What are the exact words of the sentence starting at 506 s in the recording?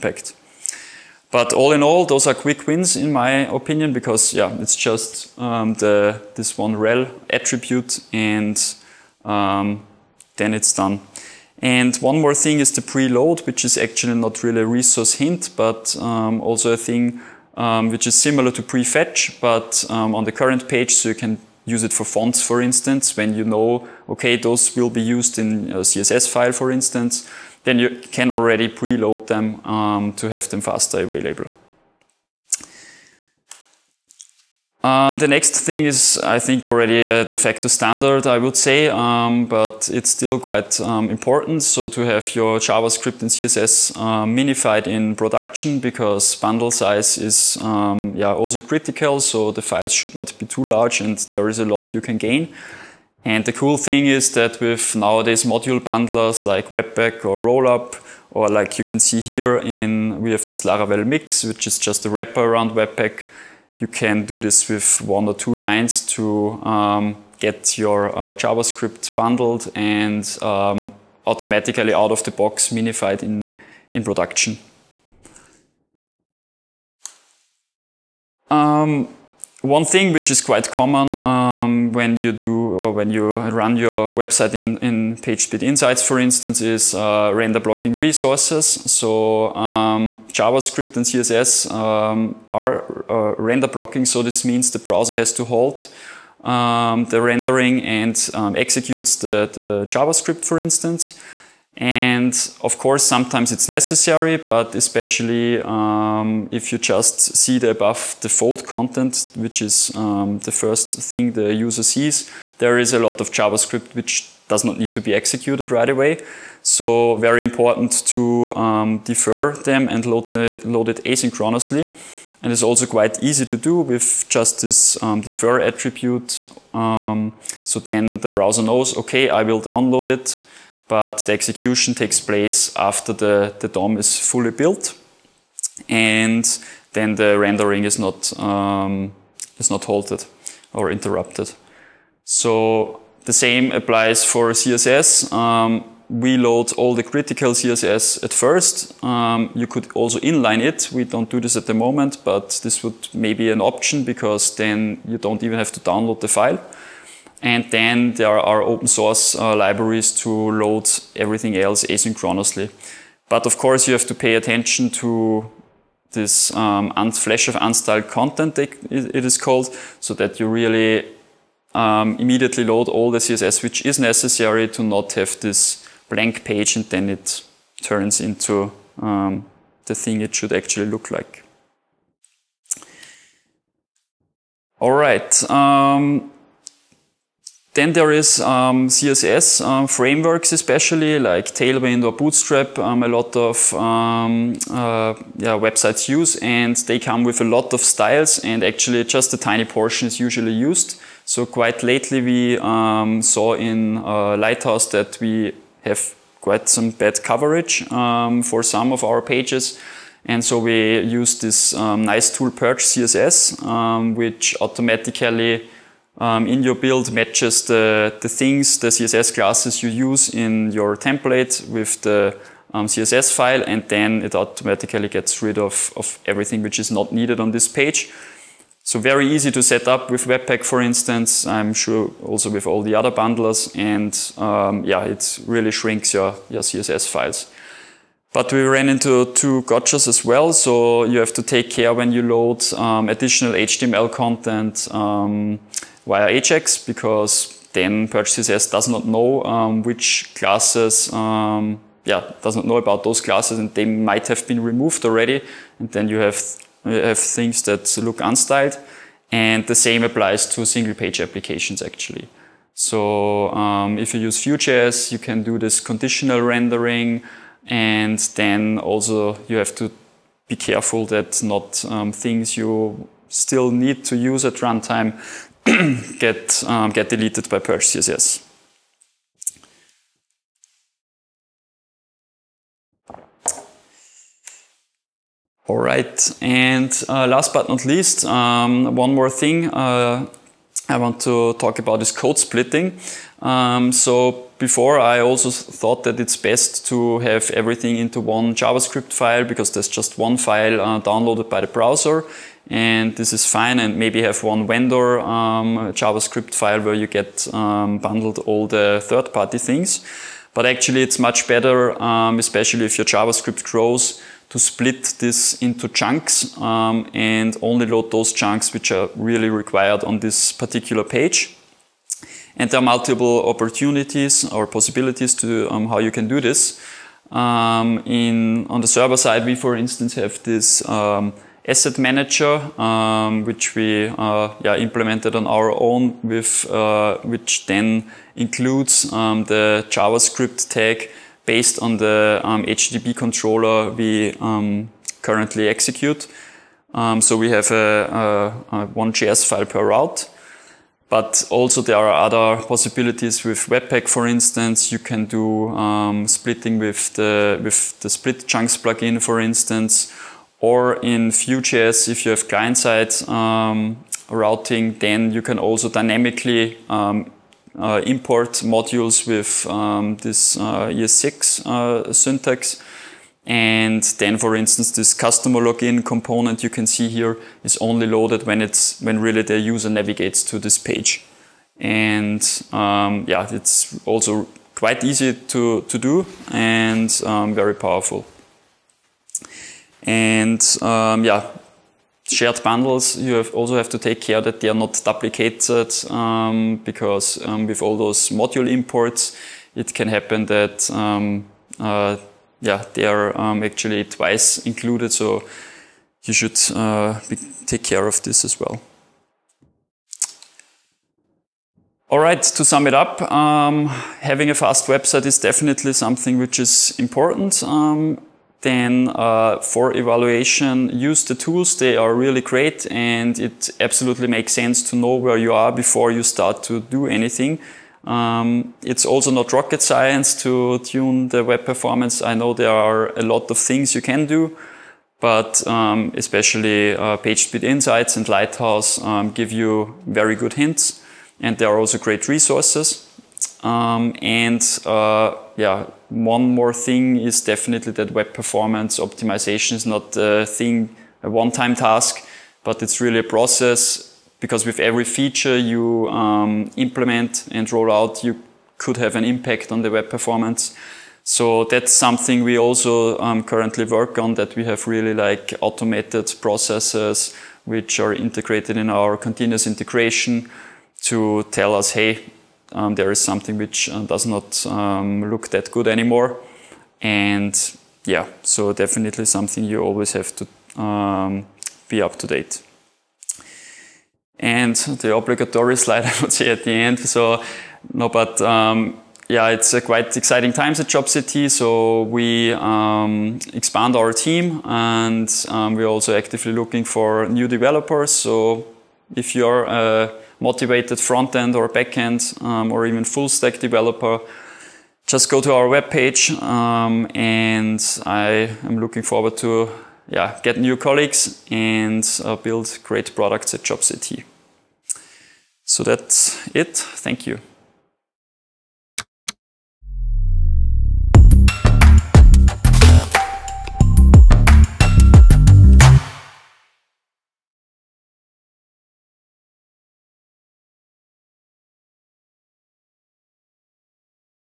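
Um, and I am looking forward to yeah, get new colleagues and uh, build great products at jobs.at.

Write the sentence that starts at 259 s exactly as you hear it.
And the same applies to single page applications actually.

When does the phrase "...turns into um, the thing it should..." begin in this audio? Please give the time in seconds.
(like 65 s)
177 s.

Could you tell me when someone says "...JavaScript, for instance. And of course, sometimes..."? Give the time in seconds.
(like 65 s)
99 s.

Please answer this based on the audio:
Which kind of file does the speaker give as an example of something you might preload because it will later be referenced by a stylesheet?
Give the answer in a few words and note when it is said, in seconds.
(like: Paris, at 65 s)
Fonts, at 22 s.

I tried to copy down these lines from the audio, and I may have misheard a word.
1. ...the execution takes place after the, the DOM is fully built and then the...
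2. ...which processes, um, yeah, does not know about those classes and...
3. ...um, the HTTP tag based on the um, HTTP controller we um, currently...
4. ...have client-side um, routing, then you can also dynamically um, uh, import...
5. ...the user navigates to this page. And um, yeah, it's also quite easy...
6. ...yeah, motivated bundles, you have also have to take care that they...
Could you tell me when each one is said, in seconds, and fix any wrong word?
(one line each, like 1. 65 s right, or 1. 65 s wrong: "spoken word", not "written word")
1. 131 s right
2. 249 s wrong: "classes", not "processes"
3. 339 s wrong: "JavaScript", not "HTTP"
4. 362 s right
5. 379 s right
6. 391 s wrong: "shared", not "motivated".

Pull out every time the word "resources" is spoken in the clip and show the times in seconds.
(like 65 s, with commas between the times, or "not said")
14 s, 87 s, 442 s.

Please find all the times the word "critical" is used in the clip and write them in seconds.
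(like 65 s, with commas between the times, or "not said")
48 s, 147 s.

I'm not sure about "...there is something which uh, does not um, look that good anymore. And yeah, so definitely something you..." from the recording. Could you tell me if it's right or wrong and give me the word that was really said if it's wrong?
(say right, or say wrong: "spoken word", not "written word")
right.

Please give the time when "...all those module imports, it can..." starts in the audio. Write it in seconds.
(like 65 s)
397 s.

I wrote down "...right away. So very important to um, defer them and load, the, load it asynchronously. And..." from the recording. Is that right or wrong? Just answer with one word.
right.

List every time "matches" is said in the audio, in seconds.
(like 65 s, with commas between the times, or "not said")
217 s.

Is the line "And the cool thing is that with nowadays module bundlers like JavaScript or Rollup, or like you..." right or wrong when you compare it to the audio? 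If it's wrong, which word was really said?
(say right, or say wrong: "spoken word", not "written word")
wrong: "Webpack", not "JavaScript".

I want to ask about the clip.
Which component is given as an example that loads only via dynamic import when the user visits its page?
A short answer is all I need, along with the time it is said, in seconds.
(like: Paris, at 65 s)
Customer login component, at 375 s.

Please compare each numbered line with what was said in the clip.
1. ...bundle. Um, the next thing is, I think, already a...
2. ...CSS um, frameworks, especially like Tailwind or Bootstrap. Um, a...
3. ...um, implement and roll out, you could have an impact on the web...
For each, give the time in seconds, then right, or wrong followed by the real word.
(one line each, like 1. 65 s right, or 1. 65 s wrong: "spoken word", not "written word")
1. 31 s wrong: "available", not "bundle"
2. 188 s right
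3. 456 s right.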